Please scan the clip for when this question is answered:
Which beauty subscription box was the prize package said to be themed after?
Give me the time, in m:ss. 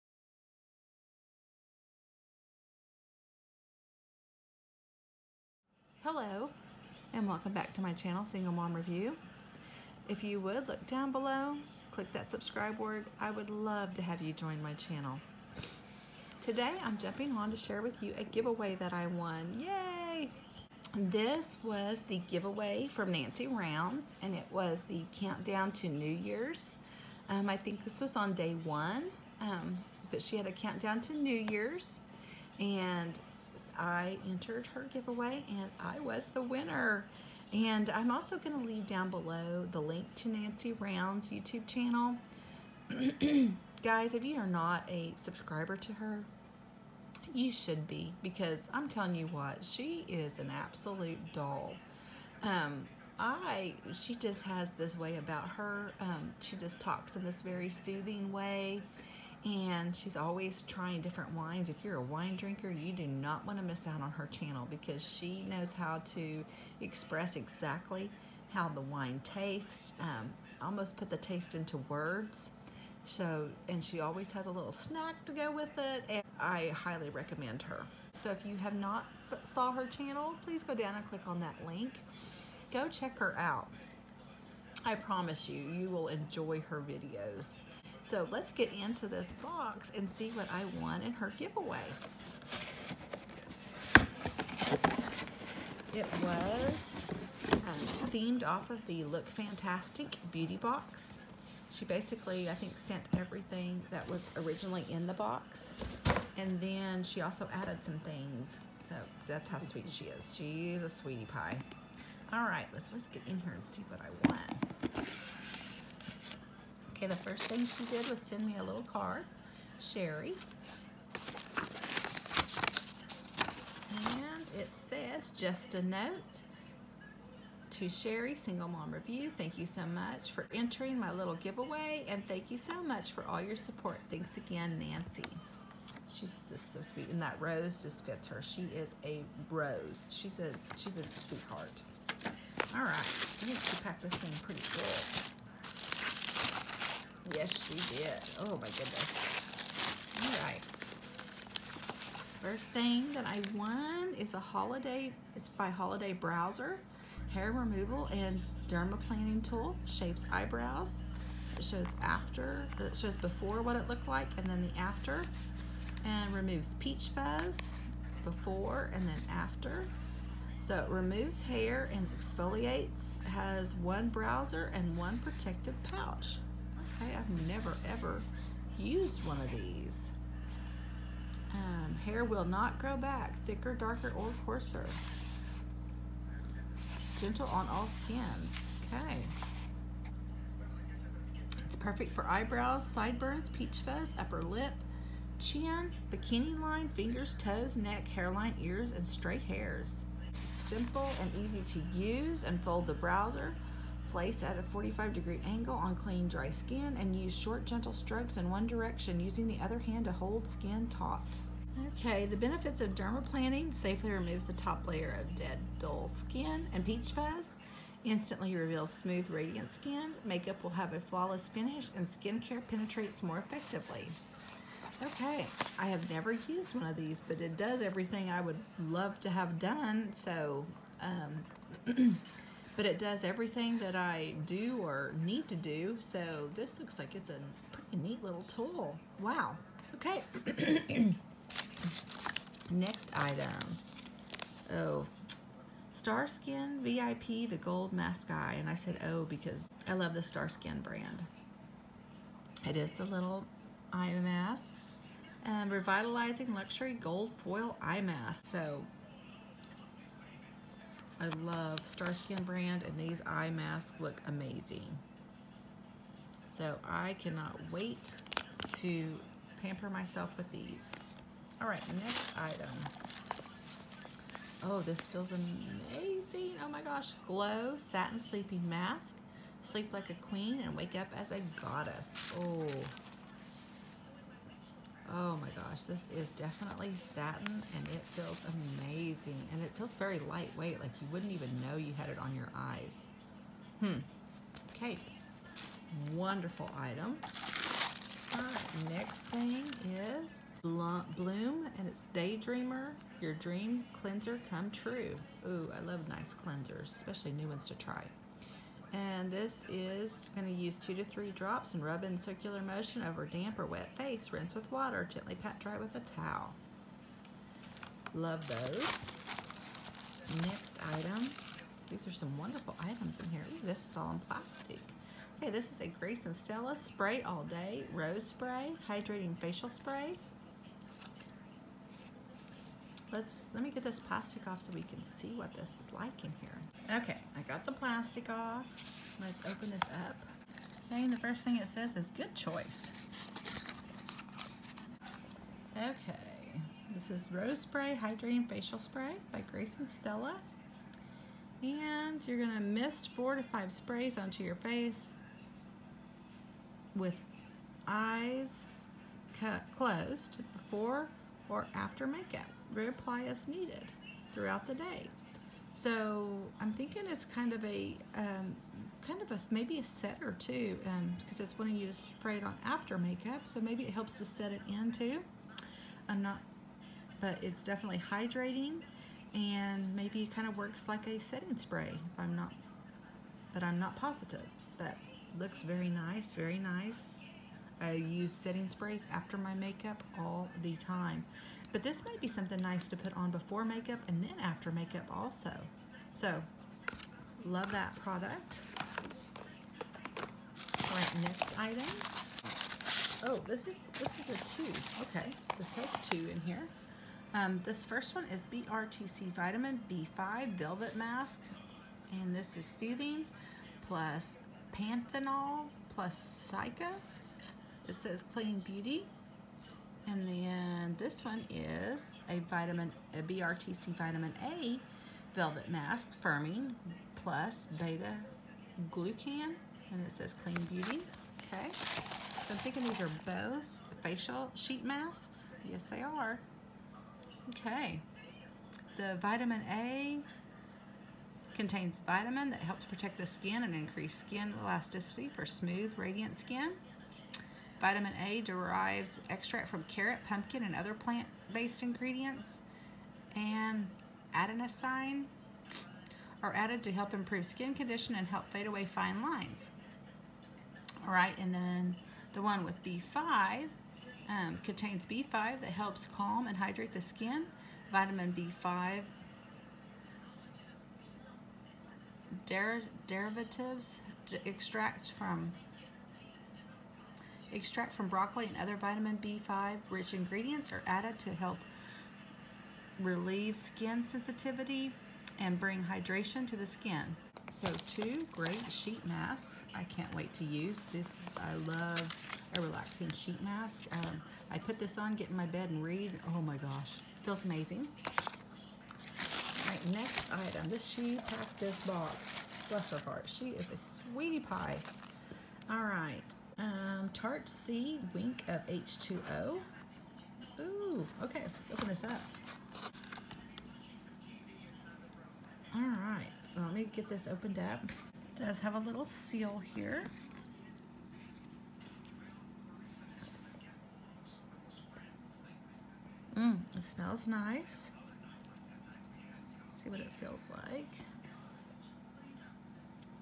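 1:39.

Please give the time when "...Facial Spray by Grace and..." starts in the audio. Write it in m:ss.
5:48.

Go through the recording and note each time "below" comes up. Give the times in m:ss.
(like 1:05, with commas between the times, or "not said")
0:11, 0:39.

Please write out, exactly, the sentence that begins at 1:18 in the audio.
So if you have not saw her channel, please go down and click on that link.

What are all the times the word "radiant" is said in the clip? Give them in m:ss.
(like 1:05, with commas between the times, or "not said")
3:39, 7:25.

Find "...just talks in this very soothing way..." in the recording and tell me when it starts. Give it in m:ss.
0:56.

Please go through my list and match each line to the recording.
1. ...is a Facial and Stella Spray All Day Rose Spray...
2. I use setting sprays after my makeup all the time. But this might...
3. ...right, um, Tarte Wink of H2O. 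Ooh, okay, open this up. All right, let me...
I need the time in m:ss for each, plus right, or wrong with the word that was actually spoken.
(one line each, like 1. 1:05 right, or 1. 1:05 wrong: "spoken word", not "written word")
1. 5:25 wrong: "Grace", not "Facial"
2. 6:27 right
3. 8:25 right.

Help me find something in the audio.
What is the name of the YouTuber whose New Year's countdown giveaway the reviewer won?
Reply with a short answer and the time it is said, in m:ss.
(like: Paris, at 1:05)
Nancy Rounds, at 0:23.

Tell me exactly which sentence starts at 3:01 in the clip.
Um, hair will not grow back, thicker, darker, or coarser.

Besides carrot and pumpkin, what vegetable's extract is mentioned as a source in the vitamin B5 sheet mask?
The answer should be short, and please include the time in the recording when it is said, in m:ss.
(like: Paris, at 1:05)
broccoli, at 7:58.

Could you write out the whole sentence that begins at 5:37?
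Okay, I got the plastic off.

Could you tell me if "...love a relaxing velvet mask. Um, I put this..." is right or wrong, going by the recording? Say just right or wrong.
wrong.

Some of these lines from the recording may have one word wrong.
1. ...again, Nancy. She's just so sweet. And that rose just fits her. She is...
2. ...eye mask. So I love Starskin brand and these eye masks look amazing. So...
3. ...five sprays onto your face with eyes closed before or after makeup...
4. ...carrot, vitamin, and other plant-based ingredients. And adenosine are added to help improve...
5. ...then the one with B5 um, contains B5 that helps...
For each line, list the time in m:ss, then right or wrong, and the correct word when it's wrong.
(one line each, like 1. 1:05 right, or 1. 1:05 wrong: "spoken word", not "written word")
1. 2:14 right
2. 4:17 right
3. 5:53 right
4. 7:29 wrong: "pumpkin", not "vitamin"
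5. 7:41 right.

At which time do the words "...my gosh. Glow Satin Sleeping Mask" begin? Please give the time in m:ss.
4:36.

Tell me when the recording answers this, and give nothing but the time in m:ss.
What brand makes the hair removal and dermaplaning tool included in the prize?
2:35.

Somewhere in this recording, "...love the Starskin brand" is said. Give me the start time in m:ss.
4:09.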